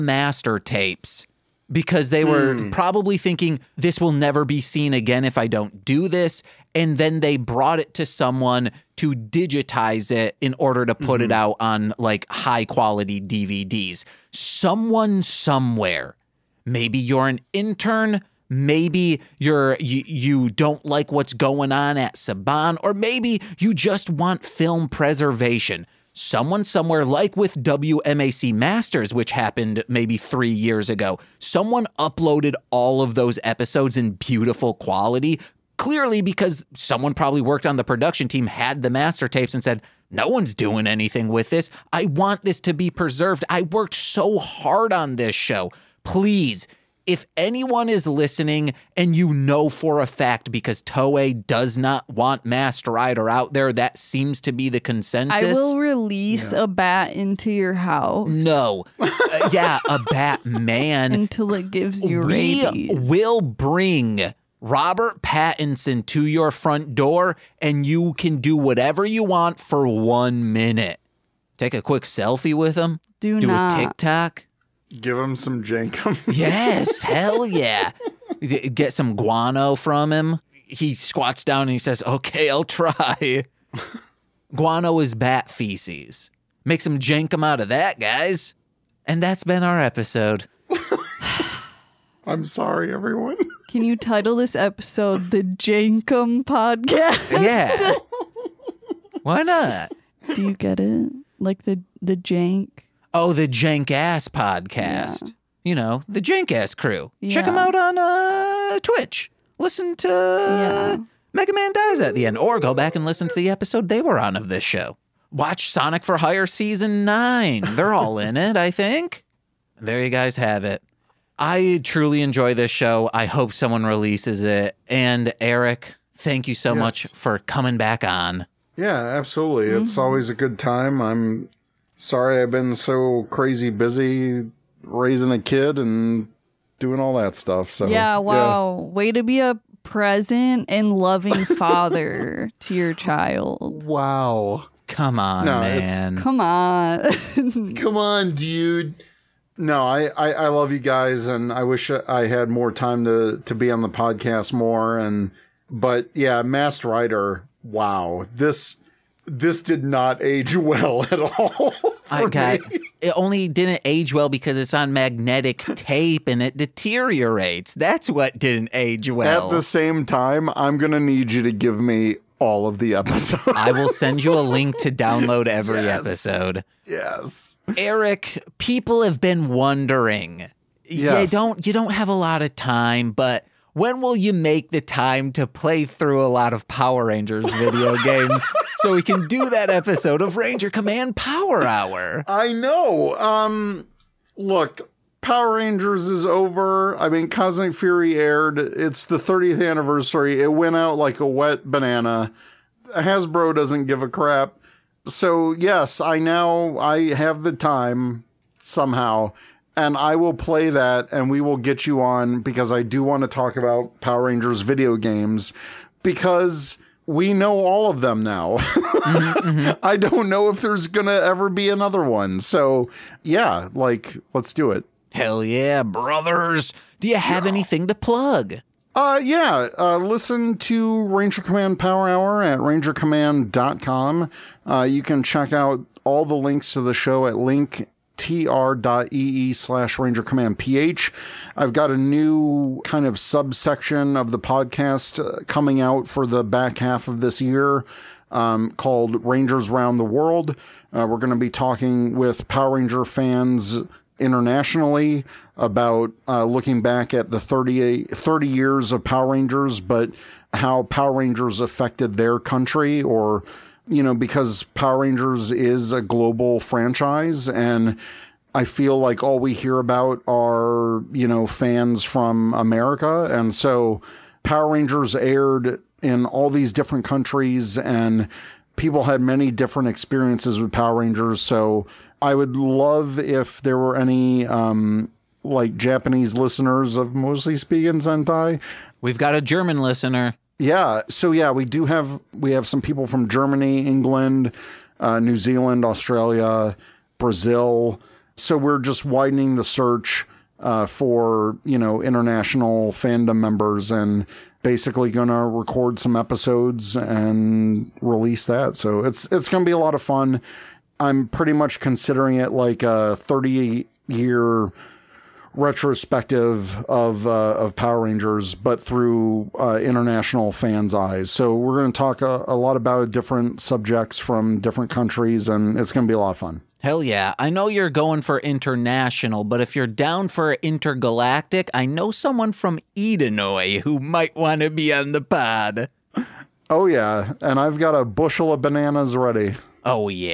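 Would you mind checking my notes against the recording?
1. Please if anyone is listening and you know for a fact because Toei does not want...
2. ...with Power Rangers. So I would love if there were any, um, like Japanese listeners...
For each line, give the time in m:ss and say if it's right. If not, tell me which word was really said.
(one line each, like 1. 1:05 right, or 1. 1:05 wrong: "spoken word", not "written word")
1. 0:46 right
2. 4:40 right.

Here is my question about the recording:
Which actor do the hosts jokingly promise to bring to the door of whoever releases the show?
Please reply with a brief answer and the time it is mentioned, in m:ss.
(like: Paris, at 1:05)
Robert Pattinson, at 1:04.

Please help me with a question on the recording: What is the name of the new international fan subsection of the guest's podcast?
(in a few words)
Rangers Round the World.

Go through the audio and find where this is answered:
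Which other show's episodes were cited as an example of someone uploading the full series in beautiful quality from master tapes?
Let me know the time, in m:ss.
0:27.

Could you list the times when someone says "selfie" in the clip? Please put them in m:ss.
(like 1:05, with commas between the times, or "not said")
1:12.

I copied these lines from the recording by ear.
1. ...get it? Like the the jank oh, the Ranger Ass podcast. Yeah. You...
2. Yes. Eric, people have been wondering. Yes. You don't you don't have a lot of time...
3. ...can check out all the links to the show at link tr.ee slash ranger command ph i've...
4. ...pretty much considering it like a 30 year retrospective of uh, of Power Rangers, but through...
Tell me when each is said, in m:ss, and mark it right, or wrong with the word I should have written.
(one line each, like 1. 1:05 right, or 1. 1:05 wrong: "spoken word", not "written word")
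1. 1:40 wrong: "Jank", not "Ranger"
2. 2:56 right
3. 3:55 right
4. 5:11 right.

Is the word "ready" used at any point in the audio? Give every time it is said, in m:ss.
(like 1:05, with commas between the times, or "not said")
5:39.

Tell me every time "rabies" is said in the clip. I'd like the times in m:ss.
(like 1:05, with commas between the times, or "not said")
1:02.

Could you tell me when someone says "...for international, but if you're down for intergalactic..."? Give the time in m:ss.
5:28.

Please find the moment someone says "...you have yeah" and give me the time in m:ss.
3:47.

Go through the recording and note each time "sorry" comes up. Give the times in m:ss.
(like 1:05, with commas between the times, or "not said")
1:32, 2:12.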